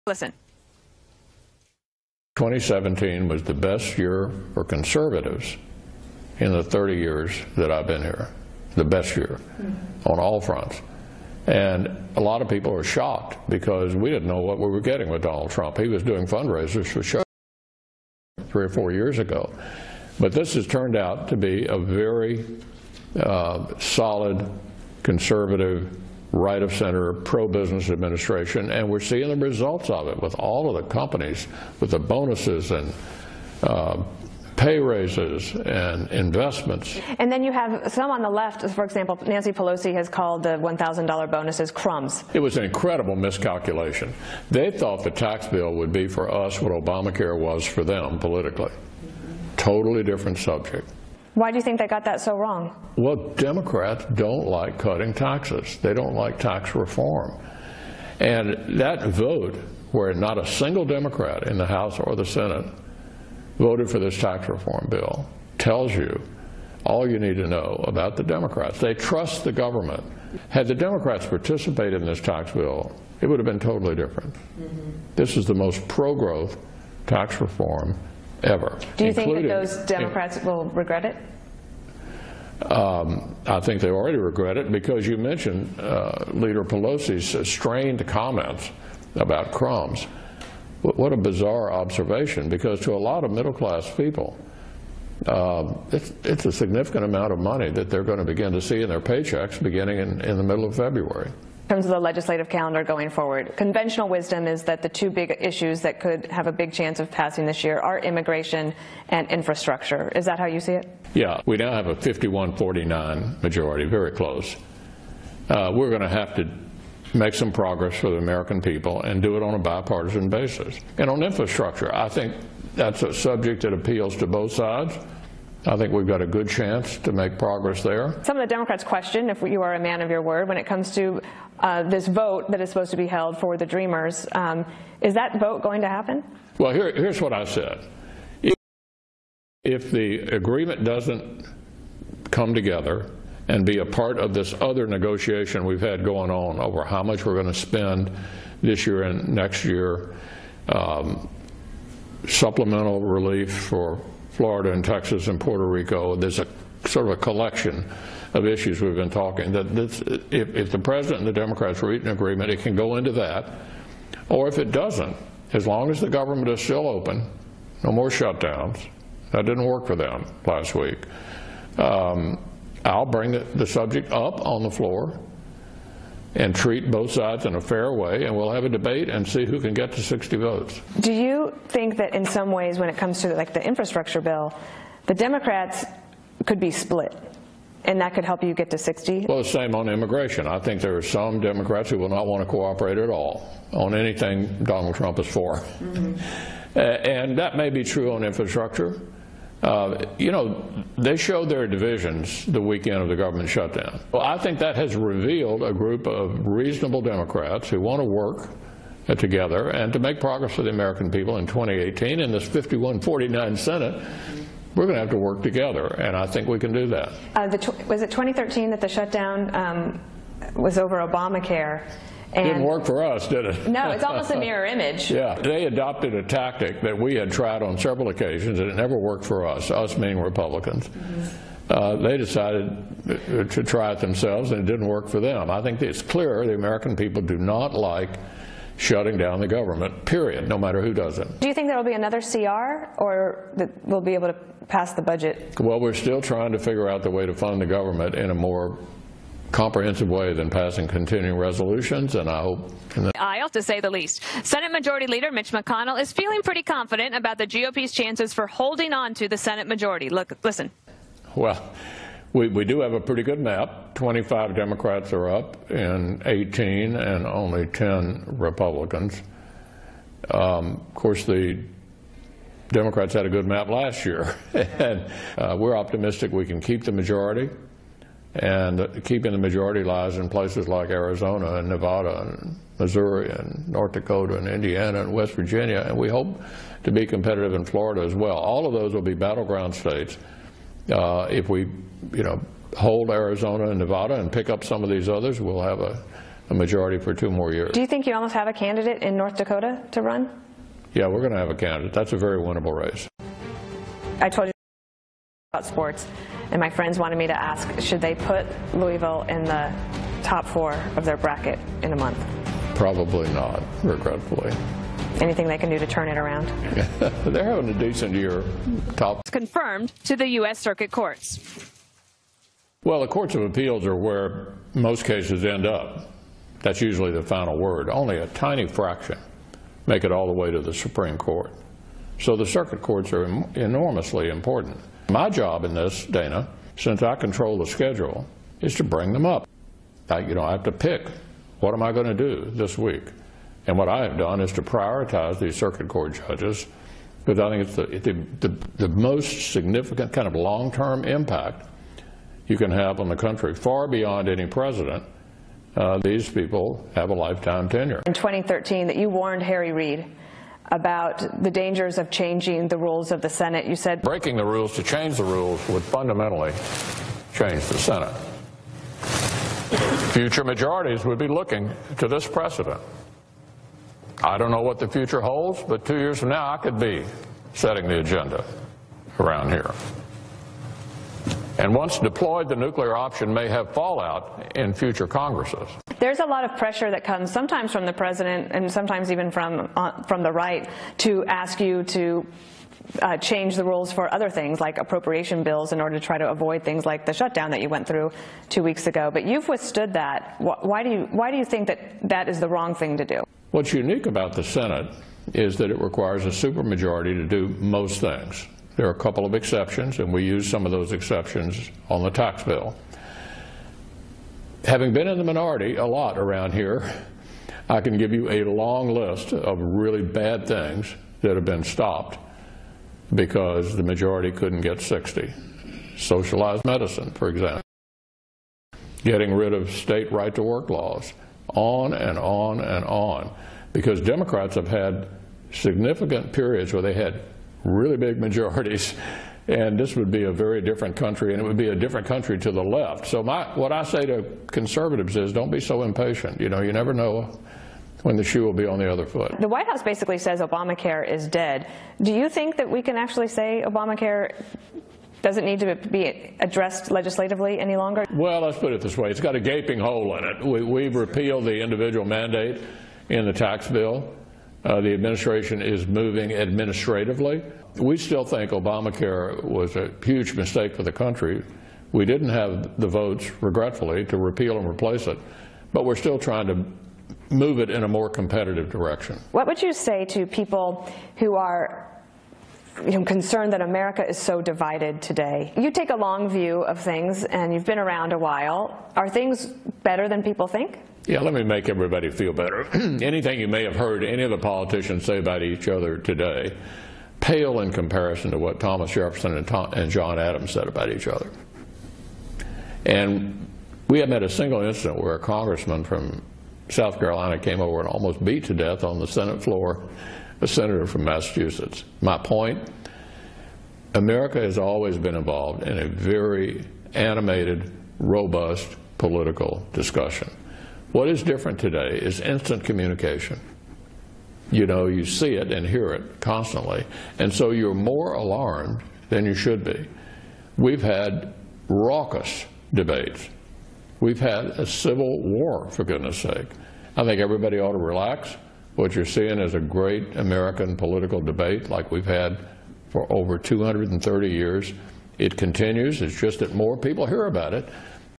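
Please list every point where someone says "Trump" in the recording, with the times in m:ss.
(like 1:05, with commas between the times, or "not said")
0:15, 3:14.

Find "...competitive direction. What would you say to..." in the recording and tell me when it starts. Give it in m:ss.
7:58.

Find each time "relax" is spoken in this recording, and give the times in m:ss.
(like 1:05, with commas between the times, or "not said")
8:57.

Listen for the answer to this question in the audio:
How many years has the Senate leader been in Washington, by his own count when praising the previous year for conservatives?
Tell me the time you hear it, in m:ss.
0:06.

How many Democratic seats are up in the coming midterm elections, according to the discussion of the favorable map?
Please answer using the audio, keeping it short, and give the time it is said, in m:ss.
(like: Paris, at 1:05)
25, at 4:23.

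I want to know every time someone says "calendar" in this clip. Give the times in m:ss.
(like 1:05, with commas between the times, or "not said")
1:42.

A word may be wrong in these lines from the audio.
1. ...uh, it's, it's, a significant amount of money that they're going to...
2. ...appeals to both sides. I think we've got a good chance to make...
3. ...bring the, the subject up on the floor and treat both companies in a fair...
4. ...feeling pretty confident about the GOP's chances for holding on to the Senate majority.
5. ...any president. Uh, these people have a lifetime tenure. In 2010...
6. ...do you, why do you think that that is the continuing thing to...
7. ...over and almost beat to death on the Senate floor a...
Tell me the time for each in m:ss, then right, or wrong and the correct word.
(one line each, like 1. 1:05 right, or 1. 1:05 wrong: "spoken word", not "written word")
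1. 1:35 right
2. 2:03 right
3. 2:53 wrong: "sides", not "companies"
4. 4:16 right
5. 5:54 wrong: "2013", not "2010"
6. 6:40 wrong: "wrong", not "continuing"
7. 8:27 right.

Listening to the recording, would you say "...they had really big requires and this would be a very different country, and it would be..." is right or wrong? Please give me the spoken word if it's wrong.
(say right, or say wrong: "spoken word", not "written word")
wrong: "majorities", not "requires".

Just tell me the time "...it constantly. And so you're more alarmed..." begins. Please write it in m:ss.
8:45.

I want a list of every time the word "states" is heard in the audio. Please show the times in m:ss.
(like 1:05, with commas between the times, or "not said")
4:49, 7:09.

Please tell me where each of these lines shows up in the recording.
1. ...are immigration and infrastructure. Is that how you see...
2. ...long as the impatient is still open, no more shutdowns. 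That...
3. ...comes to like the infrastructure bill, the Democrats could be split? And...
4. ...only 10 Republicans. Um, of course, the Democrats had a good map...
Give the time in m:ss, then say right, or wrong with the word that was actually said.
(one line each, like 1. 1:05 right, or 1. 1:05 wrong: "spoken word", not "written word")
1. 1:47 right
2. 2:45 wrong: "government", not "impatient"
3. 3:02 right
4. 4:27 right.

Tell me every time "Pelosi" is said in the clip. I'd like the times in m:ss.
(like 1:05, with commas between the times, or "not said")
0:39, 1:26.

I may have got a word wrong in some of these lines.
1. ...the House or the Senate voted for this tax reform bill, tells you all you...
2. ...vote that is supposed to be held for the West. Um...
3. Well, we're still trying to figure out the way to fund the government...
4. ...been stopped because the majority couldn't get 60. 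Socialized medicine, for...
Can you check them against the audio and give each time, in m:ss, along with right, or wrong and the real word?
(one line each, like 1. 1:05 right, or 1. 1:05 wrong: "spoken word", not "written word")
1. 1:01 right
2. 2:12 wrong: "Dreamers", not "West"
3. 4:05 right
4. 7:01 right.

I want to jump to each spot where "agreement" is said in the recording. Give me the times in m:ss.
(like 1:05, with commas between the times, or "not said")
2:20, 2:42.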